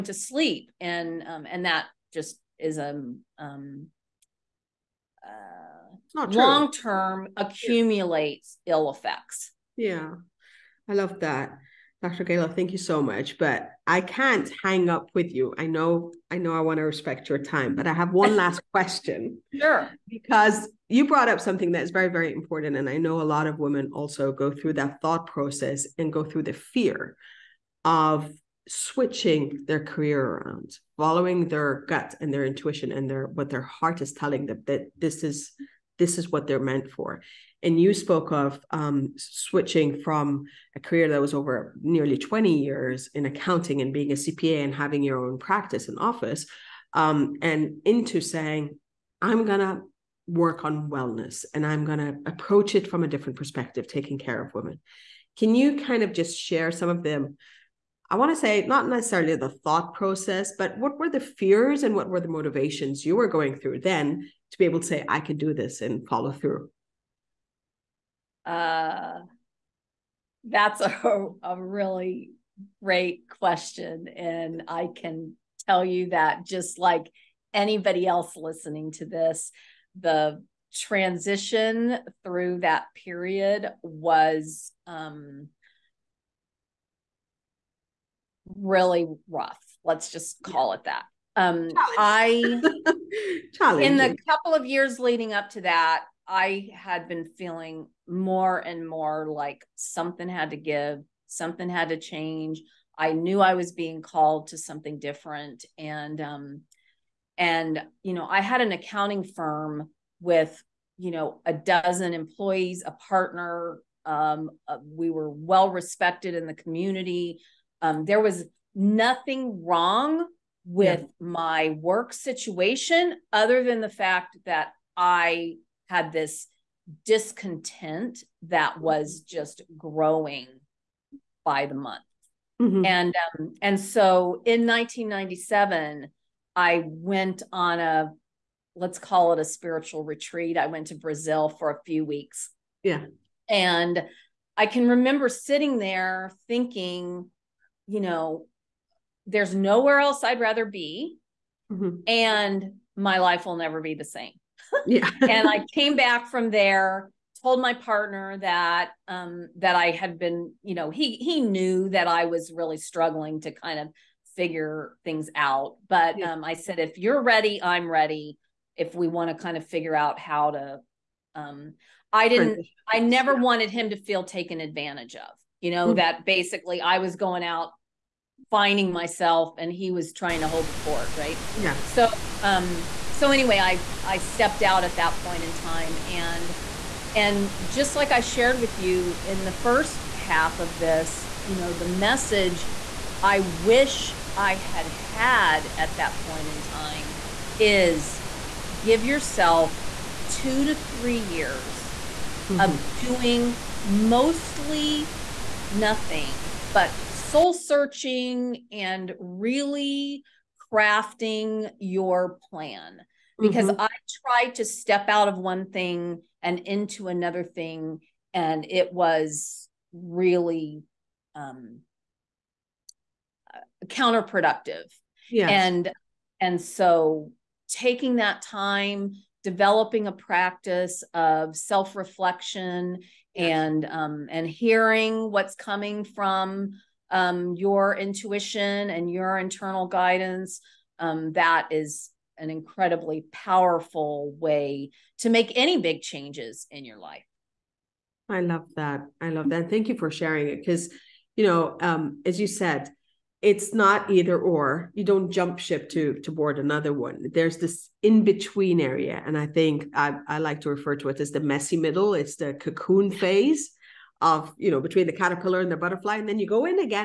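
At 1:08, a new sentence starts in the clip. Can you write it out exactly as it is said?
Uh, that's a, a really great question.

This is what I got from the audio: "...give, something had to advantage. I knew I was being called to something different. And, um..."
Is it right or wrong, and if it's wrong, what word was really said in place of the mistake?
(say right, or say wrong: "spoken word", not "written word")
wrong: "change", not "advantage".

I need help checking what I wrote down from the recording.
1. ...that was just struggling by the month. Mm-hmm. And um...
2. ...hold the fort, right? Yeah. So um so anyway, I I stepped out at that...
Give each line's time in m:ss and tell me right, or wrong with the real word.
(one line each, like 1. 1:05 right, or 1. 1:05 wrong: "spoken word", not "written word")
1. 2:08 wrong: "growing", not "struggling"
2. 3:00 right.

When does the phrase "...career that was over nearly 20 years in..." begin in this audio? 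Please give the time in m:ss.
0:40.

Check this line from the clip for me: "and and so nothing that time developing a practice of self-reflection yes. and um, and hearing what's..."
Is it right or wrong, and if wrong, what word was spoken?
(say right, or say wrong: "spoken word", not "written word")
wrong: "taking", not "nothing".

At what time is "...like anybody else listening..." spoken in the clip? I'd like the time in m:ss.
1:16.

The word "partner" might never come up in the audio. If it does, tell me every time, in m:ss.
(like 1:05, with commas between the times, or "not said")
1:52, 2:37.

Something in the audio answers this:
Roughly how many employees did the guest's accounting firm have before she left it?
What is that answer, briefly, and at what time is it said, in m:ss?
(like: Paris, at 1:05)
12, at 1:51.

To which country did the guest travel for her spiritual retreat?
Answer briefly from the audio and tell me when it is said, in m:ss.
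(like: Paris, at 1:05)
Brazil, at 2:20.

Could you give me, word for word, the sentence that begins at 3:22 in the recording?
of doing mostly nothing but soul searching and really crafting your plan because mm-hmm.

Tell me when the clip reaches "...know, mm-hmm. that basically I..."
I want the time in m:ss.
2:55.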